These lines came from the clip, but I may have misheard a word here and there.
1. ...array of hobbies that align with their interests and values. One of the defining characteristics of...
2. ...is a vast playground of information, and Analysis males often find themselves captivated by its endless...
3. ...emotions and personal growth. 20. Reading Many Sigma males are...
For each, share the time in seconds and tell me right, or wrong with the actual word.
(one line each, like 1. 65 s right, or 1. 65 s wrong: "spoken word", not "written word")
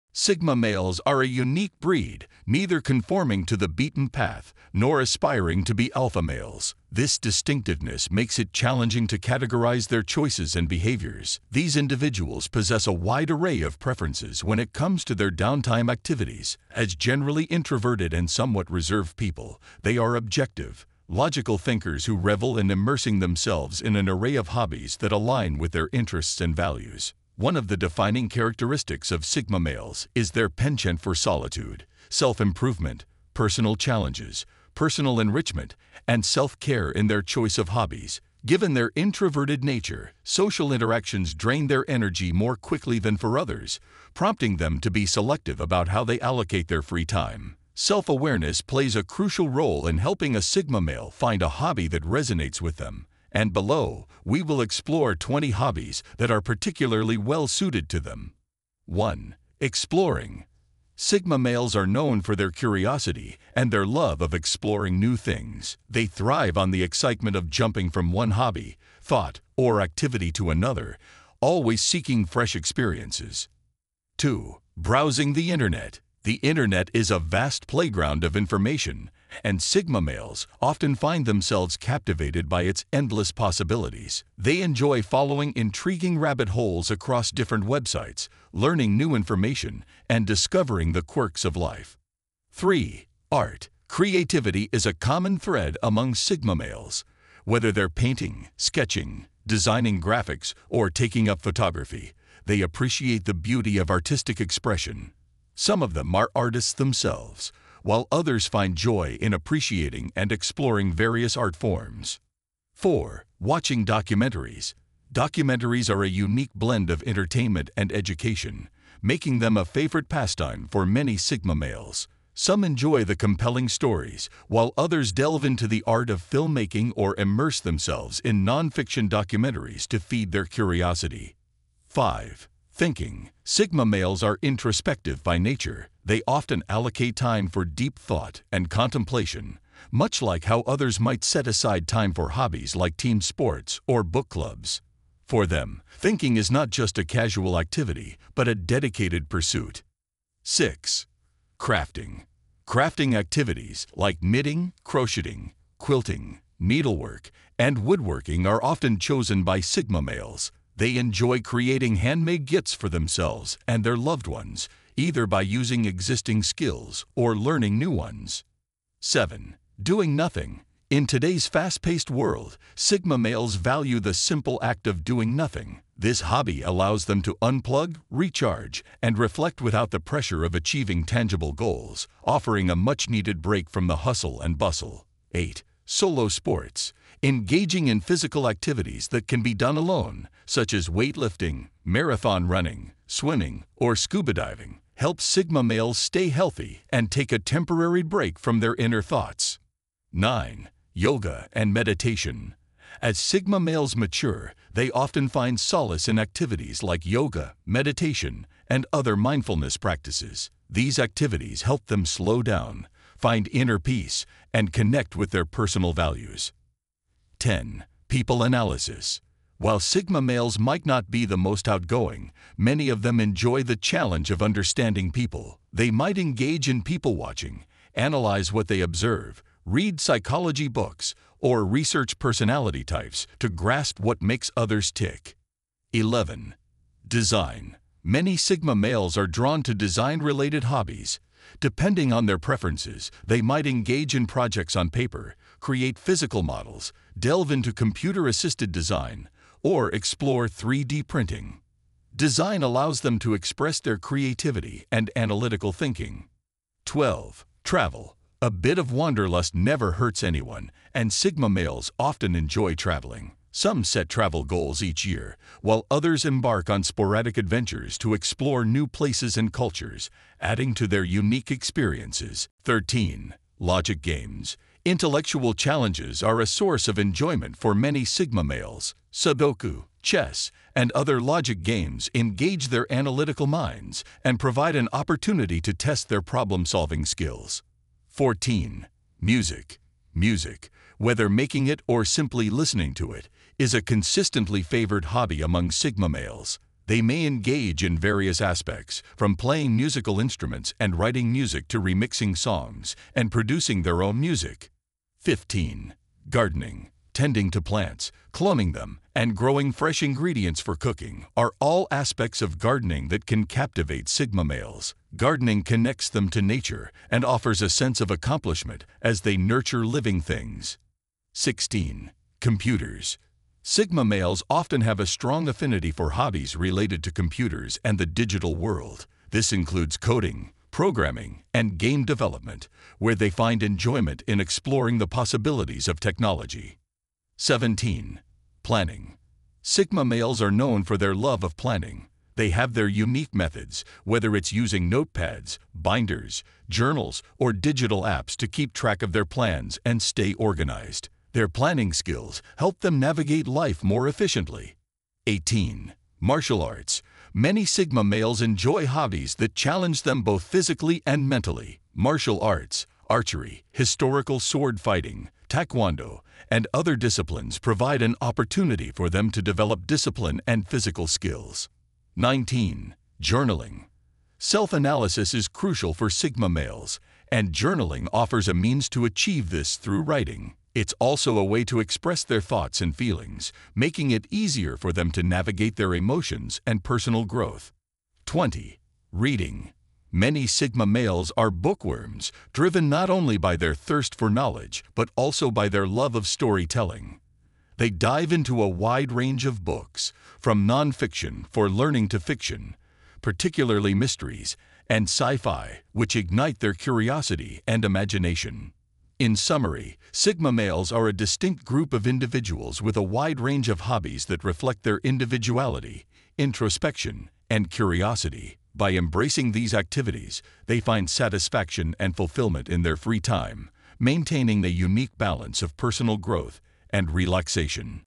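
1. 24 s right
2. 76 s wrong: "Sigma", not "Analysis"
3. 385 s right.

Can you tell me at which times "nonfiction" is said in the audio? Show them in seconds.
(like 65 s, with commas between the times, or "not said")
128 s, 400 s.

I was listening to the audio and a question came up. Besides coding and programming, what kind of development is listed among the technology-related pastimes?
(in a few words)
Game development.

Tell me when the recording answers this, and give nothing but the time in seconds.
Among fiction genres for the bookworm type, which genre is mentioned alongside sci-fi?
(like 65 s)
403 s.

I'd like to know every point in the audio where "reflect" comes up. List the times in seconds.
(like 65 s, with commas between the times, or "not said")
179 s, 414 s.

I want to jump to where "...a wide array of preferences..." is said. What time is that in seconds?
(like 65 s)
12 s.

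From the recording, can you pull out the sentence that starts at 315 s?
Gardening connects them to nature and offers a sense of accomplishment as they nurture living things.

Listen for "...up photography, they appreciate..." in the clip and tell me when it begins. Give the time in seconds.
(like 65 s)
101 s.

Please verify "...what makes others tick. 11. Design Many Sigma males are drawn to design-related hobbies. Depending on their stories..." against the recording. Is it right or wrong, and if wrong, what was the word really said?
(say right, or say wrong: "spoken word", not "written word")
wrong: "preferences", not "stories".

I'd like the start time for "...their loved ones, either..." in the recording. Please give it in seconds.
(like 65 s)
163 s.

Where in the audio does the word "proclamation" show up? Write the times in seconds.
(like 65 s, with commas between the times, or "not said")
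not said.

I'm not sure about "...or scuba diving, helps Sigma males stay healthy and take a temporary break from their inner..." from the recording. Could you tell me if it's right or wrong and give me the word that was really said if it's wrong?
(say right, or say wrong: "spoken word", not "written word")
right.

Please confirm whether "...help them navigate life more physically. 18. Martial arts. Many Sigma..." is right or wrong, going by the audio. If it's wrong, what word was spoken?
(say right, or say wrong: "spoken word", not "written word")
wrong: "efficiently", not "physically".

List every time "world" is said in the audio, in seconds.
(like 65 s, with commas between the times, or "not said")
172 s, 328 s.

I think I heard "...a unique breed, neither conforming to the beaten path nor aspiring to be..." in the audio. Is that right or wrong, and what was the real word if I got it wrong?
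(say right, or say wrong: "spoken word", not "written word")
right.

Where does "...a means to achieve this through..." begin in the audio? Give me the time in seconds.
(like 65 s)
378 s.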